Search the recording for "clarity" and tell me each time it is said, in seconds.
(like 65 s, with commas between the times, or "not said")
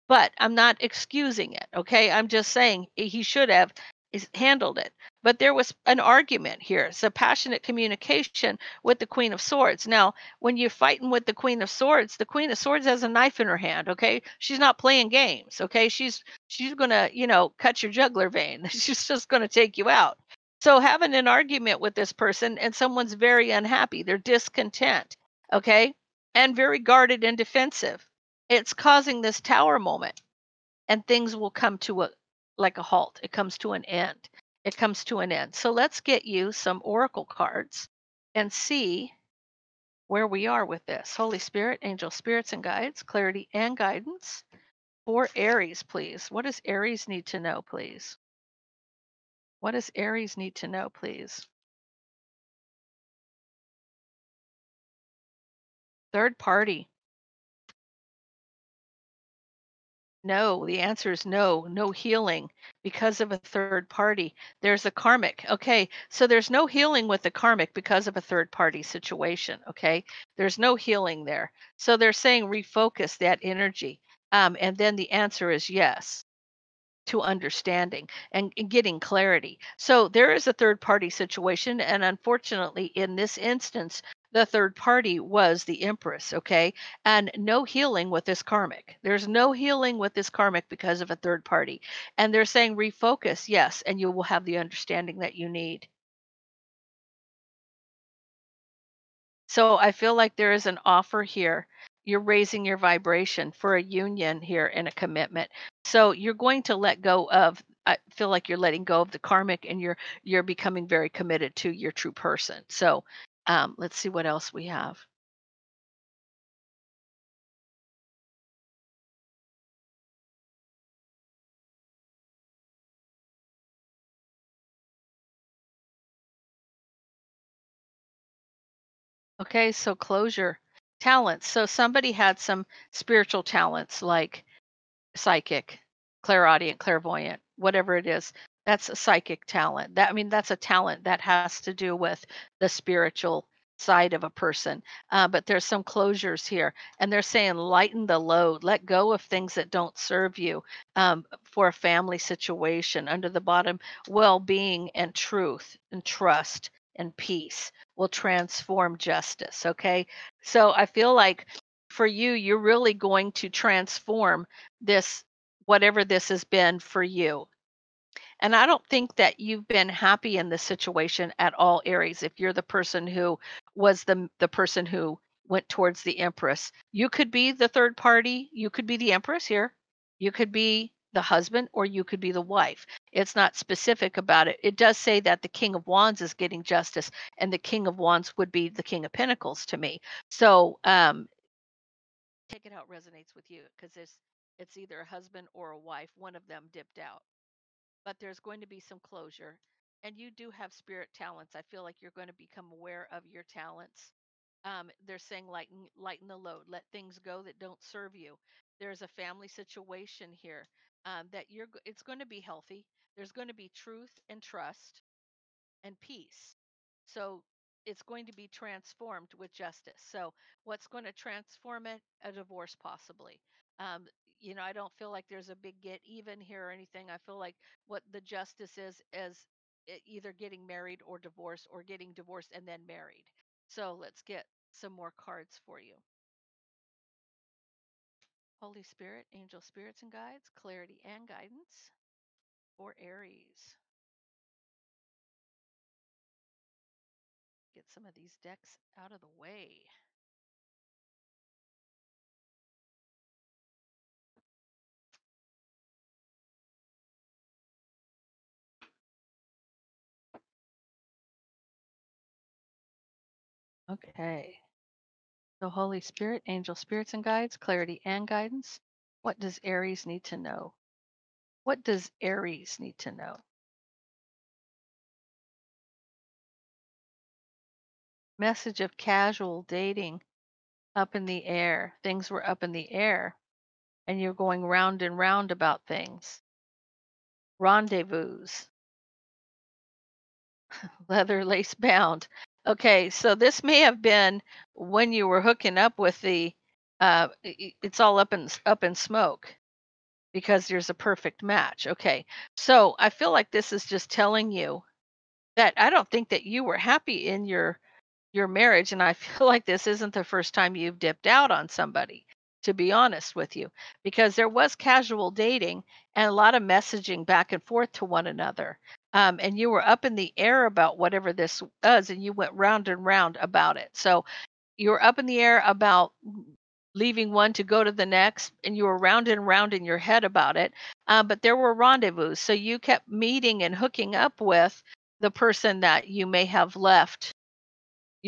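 43 s, 78 s, 240 s, 267 s.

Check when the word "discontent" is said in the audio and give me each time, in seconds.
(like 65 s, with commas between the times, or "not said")
24 s.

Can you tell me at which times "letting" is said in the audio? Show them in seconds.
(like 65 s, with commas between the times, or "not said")
108 s.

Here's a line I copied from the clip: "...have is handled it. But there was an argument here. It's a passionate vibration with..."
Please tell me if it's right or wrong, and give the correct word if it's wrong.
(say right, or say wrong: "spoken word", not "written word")
wrong: "communication", not "vibration".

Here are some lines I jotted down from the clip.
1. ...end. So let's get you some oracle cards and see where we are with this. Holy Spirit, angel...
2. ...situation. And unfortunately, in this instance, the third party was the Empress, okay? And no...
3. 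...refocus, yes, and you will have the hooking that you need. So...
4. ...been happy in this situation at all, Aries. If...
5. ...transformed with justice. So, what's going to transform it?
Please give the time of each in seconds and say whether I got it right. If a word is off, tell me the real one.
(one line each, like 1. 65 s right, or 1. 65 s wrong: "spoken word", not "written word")
1. 35 s right
2. 81 s right
3. 92 s wrong: "understanding", not "hooking"
4. 169 s right
5. 218 s right.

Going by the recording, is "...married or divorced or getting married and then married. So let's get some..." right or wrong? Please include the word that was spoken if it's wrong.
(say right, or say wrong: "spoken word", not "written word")
wrong: "divorced", not "married".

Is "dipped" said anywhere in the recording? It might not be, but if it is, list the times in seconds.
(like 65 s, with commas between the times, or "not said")
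196 s, 310 s.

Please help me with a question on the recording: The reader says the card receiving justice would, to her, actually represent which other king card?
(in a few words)
King of Pentacles.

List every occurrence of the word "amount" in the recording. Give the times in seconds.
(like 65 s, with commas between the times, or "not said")
not said.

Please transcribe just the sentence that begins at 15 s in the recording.
Okay, she's she's gonna you know cut your jugular vein.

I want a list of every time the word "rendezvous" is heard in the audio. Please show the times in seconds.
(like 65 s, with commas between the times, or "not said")
287 s, 331 s.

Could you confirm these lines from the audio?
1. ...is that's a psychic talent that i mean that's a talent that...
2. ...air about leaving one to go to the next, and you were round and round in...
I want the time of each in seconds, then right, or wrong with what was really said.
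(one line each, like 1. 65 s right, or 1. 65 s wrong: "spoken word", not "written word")
1. 138 s right
2. 325 s right.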